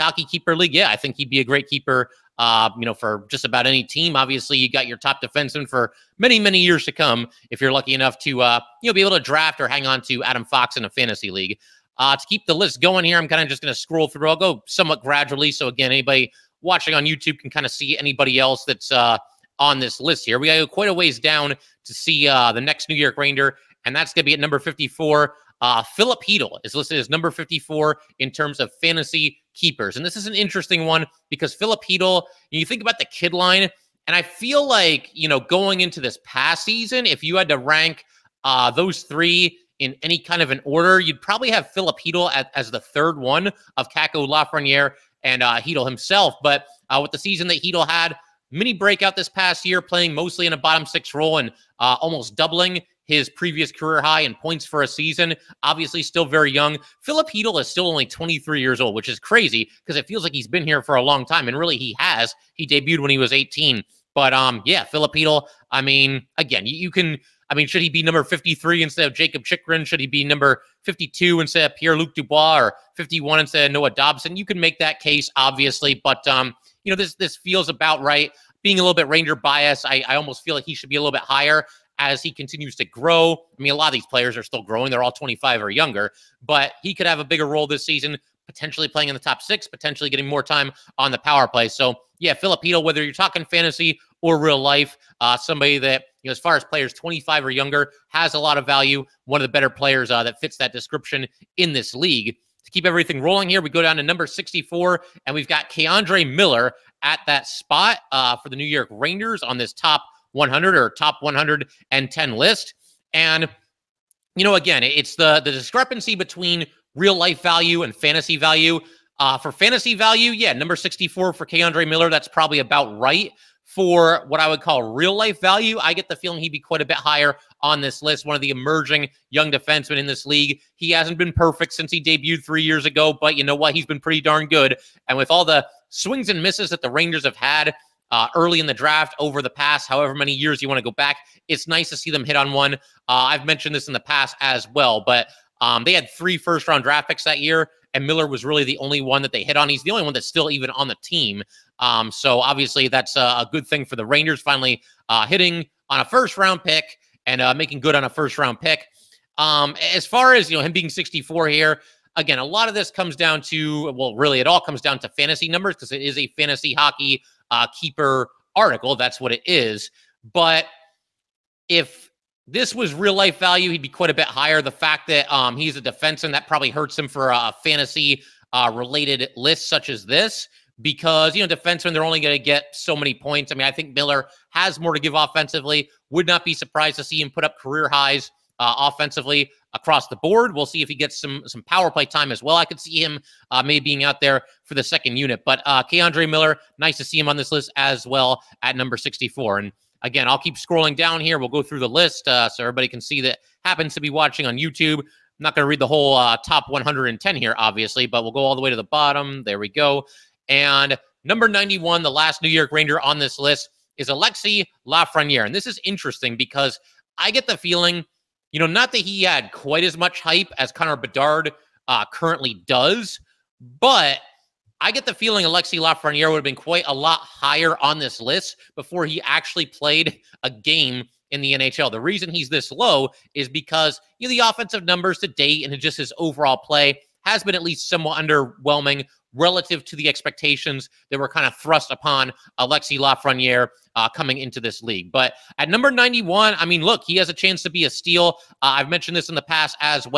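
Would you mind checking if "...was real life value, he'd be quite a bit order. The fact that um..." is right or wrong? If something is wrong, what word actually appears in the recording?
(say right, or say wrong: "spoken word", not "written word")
wrong: "higher", not "order".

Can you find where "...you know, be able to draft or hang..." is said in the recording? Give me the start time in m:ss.
0:08.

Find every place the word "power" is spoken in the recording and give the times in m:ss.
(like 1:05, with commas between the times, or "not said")
1:31, 3:11.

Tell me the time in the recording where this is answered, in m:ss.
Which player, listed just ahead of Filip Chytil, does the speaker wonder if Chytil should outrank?
1:09.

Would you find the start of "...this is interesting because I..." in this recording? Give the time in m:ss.
3:35.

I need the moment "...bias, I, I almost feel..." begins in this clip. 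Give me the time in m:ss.
1:19.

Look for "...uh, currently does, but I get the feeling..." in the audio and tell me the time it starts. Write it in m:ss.
3:41.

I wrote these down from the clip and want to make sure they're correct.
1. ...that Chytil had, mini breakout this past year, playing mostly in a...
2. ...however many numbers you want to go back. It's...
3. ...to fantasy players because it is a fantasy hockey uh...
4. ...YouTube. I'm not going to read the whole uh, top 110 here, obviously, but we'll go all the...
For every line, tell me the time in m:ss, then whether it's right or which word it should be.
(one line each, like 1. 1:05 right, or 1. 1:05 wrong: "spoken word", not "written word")
1. 0:47 right
2. 2:19 wrong: "years", not "numbers"
3. 2:44 wrong: "numbers", not "players"
4. 3:24 right.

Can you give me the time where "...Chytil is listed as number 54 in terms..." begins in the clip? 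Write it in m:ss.
0:26.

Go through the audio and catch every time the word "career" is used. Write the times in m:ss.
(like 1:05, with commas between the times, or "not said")
0:53, 3:07.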